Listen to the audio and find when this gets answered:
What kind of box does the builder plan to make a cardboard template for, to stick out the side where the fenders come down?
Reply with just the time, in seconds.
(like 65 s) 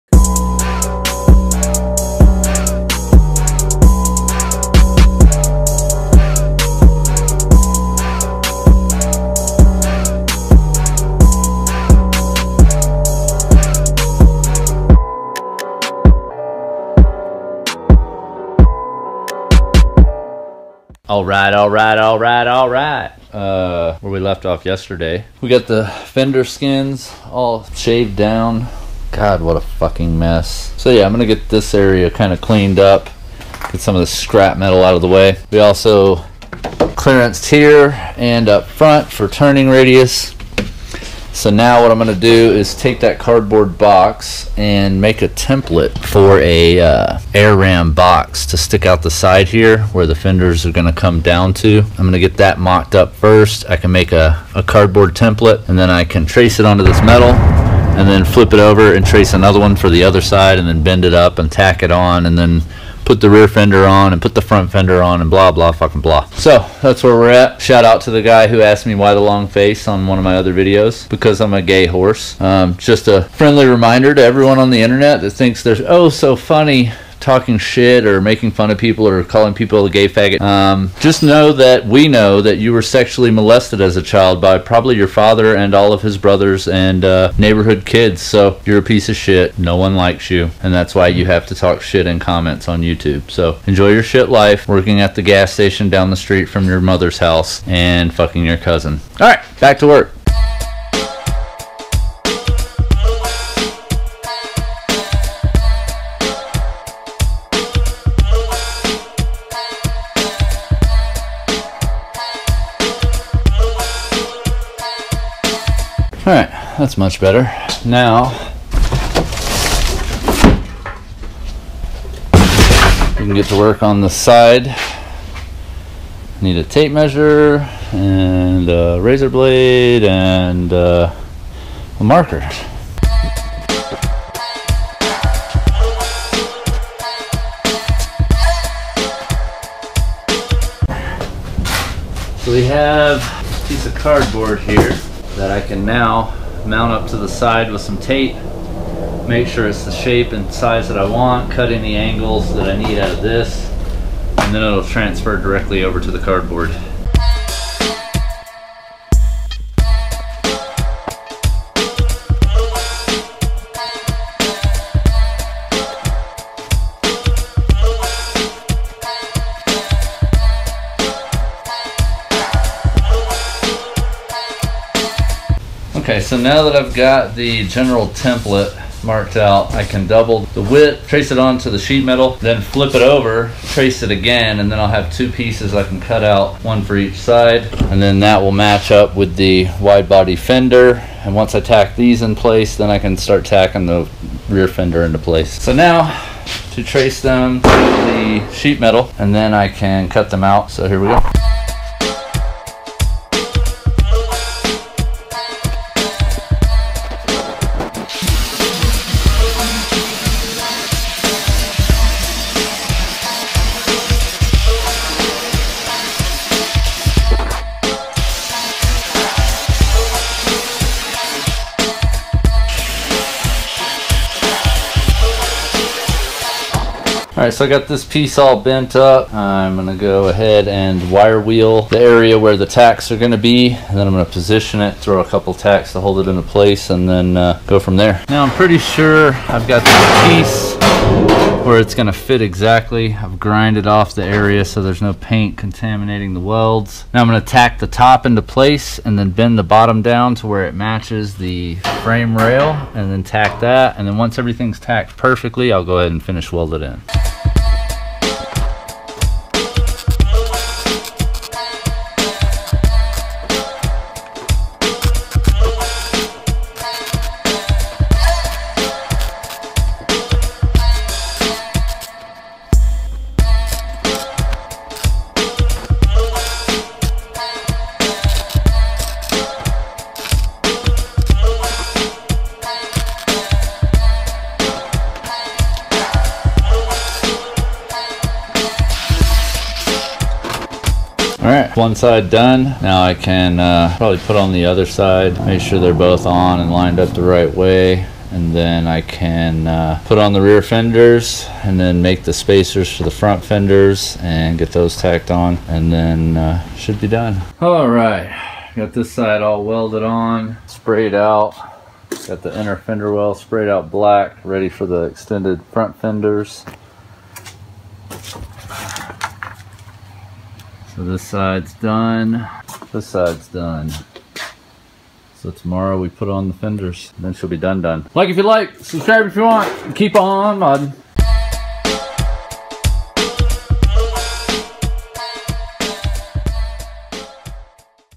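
47 s.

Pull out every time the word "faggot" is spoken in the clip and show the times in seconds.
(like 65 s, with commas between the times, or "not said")
80 s.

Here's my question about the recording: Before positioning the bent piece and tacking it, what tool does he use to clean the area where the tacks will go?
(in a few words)
Wire wheel.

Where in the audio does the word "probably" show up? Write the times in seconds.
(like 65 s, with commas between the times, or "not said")
84 s, 293 s.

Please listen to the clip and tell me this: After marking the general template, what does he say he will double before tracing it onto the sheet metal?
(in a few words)
The width.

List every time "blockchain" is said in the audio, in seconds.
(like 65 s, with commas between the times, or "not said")
not said.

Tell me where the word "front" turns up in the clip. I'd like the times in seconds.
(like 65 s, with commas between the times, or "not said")
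38 s, 64 s, 303 s, 315 s.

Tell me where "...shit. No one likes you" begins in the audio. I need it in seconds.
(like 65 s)
89 s.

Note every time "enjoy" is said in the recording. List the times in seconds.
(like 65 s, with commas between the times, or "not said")
93 s.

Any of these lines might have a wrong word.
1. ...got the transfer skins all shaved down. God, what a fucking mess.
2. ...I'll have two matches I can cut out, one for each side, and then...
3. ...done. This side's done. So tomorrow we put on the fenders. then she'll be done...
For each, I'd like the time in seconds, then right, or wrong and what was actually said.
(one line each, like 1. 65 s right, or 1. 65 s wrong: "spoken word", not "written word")
1. 25 s wrong: "fender", not "transfer"
2. 184 s wrong: "pieces", not "matches"
3. 321 s right.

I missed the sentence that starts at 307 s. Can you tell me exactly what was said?
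Alright, got this side all welded on, sprayed out.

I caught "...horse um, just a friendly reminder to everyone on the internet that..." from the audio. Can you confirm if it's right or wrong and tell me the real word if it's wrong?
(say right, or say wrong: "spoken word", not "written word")
right.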